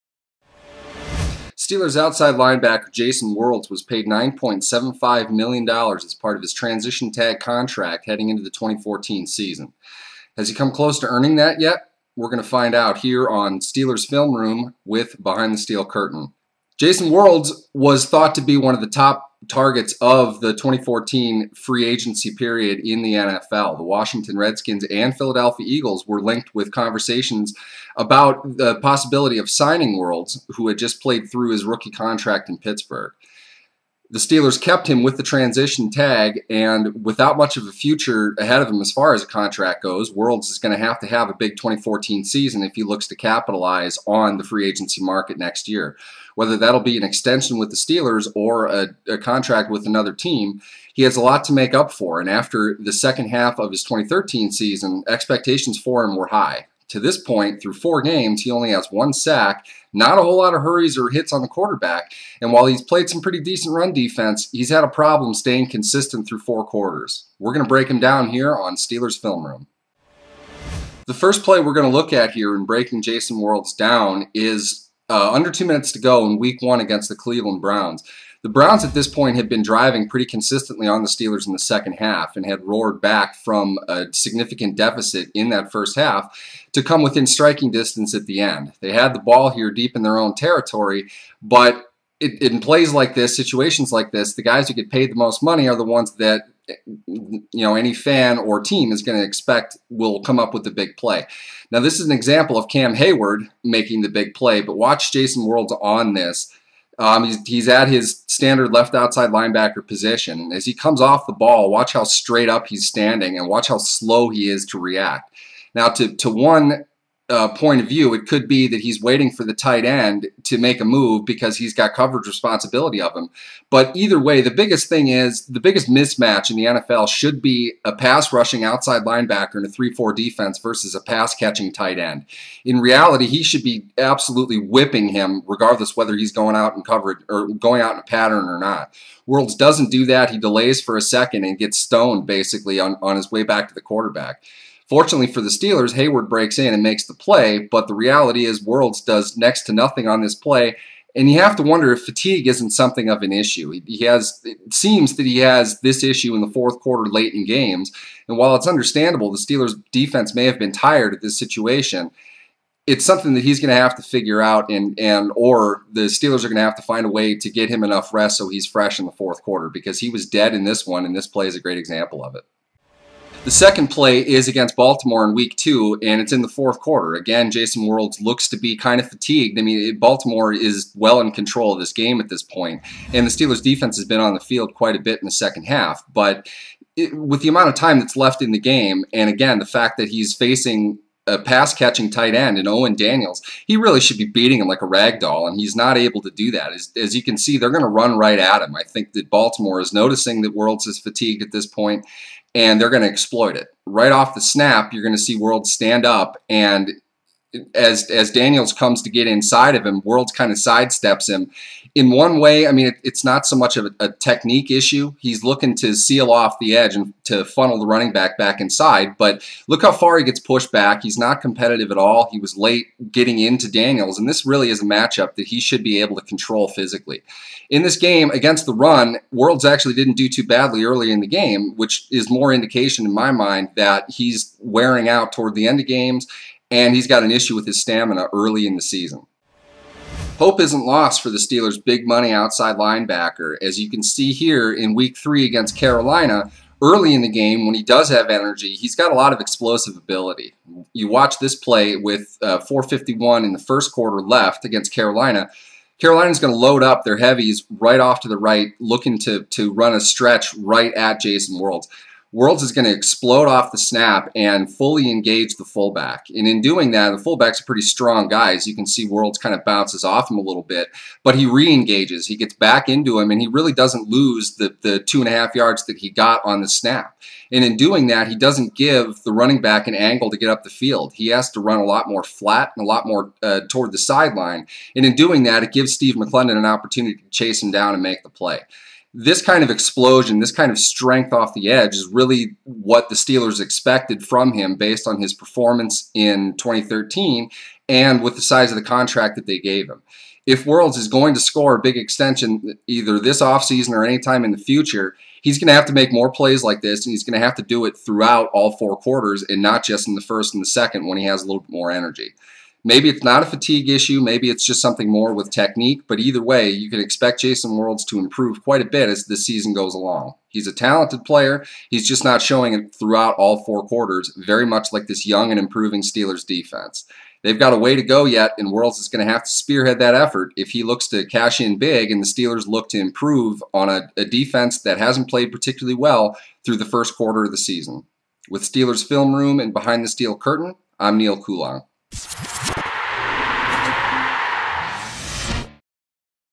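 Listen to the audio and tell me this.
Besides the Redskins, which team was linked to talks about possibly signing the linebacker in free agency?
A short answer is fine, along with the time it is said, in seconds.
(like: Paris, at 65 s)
Philadelphia Eagles, at 25 s.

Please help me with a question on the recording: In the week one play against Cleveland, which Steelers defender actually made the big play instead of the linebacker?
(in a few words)
Cam Heyward.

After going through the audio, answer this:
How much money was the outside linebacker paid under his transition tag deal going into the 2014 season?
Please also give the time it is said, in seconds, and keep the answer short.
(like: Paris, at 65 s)
$9.75 million, at 4 s.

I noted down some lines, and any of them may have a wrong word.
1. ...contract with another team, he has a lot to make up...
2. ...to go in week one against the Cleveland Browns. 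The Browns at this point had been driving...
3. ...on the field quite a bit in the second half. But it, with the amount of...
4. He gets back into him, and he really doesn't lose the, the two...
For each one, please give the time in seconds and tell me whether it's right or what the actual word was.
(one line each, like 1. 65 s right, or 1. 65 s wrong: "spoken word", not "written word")
1. 49 s right
2. 75 s right
3. 184 s right
4. 272 s right.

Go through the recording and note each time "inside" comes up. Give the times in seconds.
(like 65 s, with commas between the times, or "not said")
209 s, 218 s.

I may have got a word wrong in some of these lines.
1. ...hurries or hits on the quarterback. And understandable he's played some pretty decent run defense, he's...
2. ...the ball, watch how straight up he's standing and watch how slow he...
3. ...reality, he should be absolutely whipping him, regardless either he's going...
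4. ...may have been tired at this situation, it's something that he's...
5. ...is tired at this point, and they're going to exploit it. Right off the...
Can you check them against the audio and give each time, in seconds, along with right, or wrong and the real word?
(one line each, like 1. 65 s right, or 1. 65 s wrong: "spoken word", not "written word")
1. 60 s wrong: "while", not "understandable"
2. 111 s right
3. 132 s wrong: "whether", not "either"
4. 160 s right
5. 200 s wrong: "fatigued", not "tired".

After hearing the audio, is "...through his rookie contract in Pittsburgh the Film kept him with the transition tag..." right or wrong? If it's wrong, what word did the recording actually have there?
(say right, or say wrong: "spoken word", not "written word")
wrong: "Steelers", not "Film".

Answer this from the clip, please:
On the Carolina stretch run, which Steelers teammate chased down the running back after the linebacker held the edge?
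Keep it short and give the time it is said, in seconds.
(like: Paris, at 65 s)
Steve McLendon, at 285 s.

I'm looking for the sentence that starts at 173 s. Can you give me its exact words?
The second play is against Baltimore in week two, and it's in the fourth quarter.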